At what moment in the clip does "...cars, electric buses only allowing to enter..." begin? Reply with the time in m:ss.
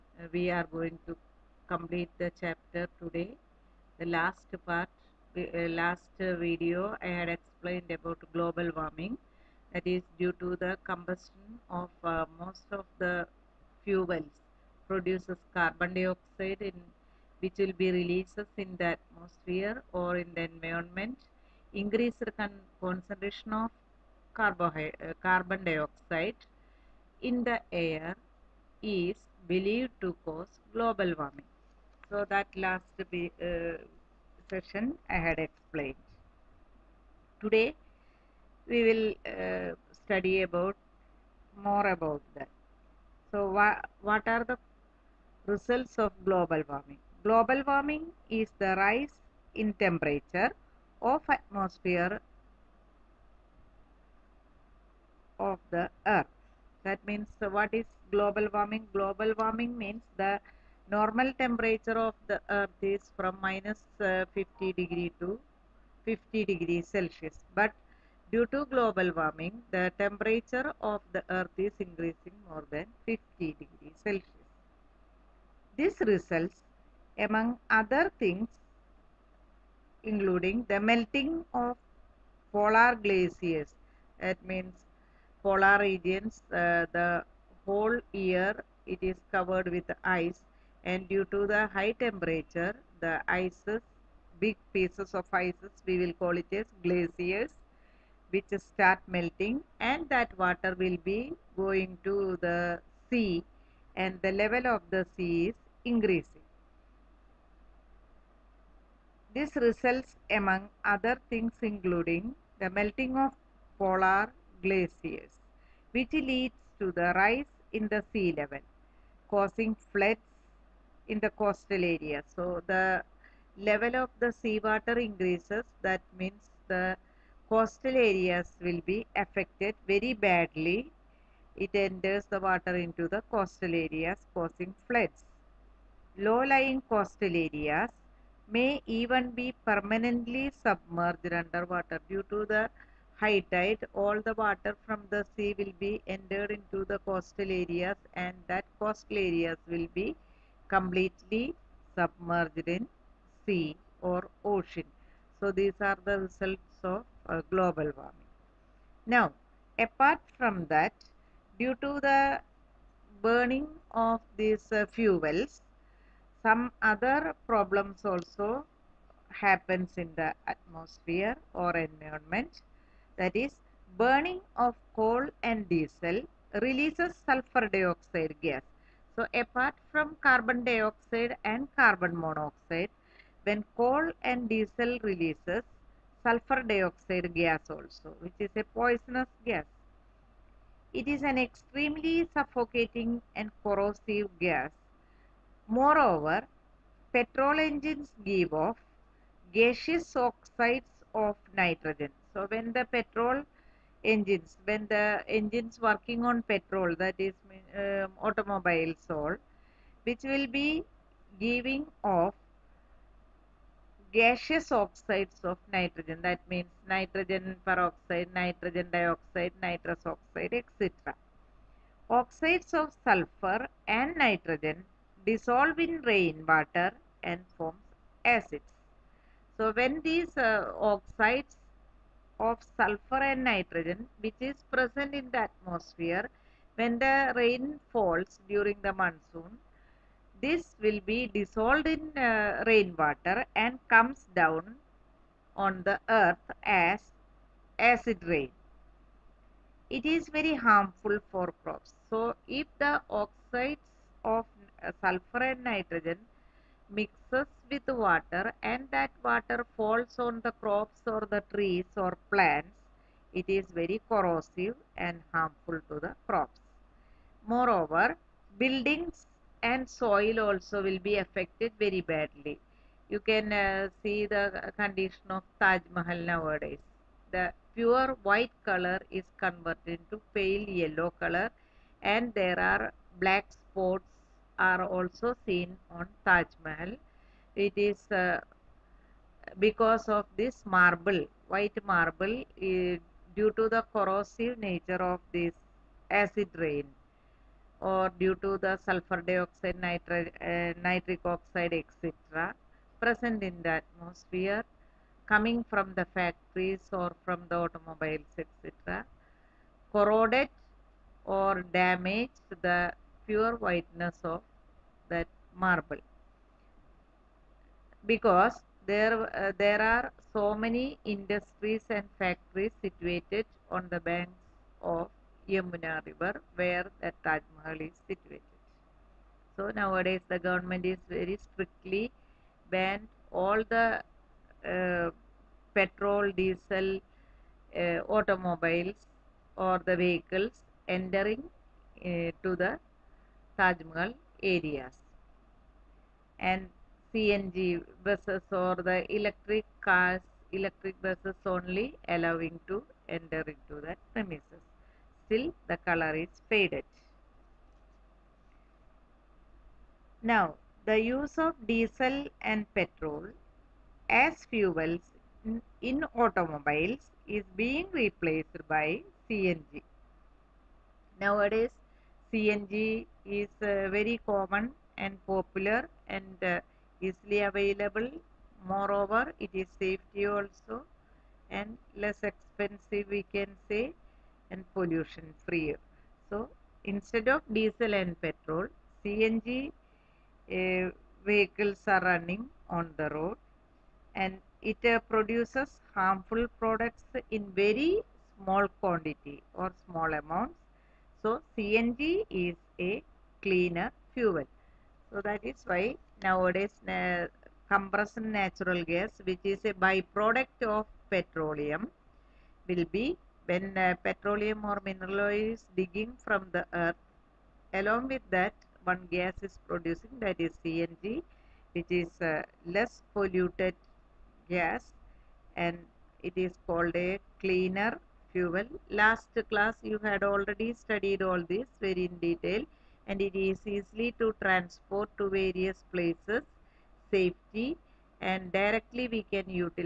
5:49.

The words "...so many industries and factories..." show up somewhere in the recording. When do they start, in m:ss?
5:20.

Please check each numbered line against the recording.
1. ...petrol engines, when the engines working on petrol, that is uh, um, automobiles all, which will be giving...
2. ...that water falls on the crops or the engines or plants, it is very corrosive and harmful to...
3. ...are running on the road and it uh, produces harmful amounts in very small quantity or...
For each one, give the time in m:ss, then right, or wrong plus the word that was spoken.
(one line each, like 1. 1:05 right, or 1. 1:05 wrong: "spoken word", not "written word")
1. 3:22 right
2. 4:18 wrong: "trees", not "engines"
3. 6:31 wrong: "products", not "amounts".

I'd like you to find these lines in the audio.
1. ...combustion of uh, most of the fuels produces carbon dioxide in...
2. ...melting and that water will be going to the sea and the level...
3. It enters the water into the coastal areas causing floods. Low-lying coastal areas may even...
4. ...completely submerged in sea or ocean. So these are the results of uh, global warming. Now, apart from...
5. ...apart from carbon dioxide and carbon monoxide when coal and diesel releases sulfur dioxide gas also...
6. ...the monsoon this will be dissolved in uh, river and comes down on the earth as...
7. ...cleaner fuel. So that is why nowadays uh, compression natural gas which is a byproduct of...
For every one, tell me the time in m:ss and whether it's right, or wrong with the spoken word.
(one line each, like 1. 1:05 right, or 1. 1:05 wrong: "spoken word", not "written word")
1. 0:10 right
2. 1:39 right
3. 2:11 right
4. 2:30 right
5. 2:59 right
6. 3:58 wrong: "rainwater", not "river"
7. 6:43 right.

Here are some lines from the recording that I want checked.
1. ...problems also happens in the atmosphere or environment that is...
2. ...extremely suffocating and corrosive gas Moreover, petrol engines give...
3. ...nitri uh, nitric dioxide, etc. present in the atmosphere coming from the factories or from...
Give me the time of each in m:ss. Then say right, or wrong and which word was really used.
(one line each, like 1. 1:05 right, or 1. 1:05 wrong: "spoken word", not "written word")
1. 2:47 right
2. 3:11 right
3. 4:59 wrong: "oxide", not "dioxide".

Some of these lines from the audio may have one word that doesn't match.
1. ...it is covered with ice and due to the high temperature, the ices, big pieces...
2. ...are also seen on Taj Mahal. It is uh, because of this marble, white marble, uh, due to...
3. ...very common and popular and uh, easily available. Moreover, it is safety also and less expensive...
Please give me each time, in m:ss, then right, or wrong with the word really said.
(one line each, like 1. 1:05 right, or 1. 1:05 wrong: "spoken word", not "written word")
1. 1:28 right
2. 4:44 right
3. 6:13 right.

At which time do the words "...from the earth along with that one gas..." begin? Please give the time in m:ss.
6:56.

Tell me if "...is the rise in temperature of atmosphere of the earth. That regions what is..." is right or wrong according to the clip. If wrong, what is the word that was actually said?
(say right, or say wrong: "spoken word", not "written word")
wrong: "means", not "regions".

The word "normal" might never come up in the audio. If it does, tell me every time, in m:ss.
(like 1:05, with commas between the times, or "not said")
1:00.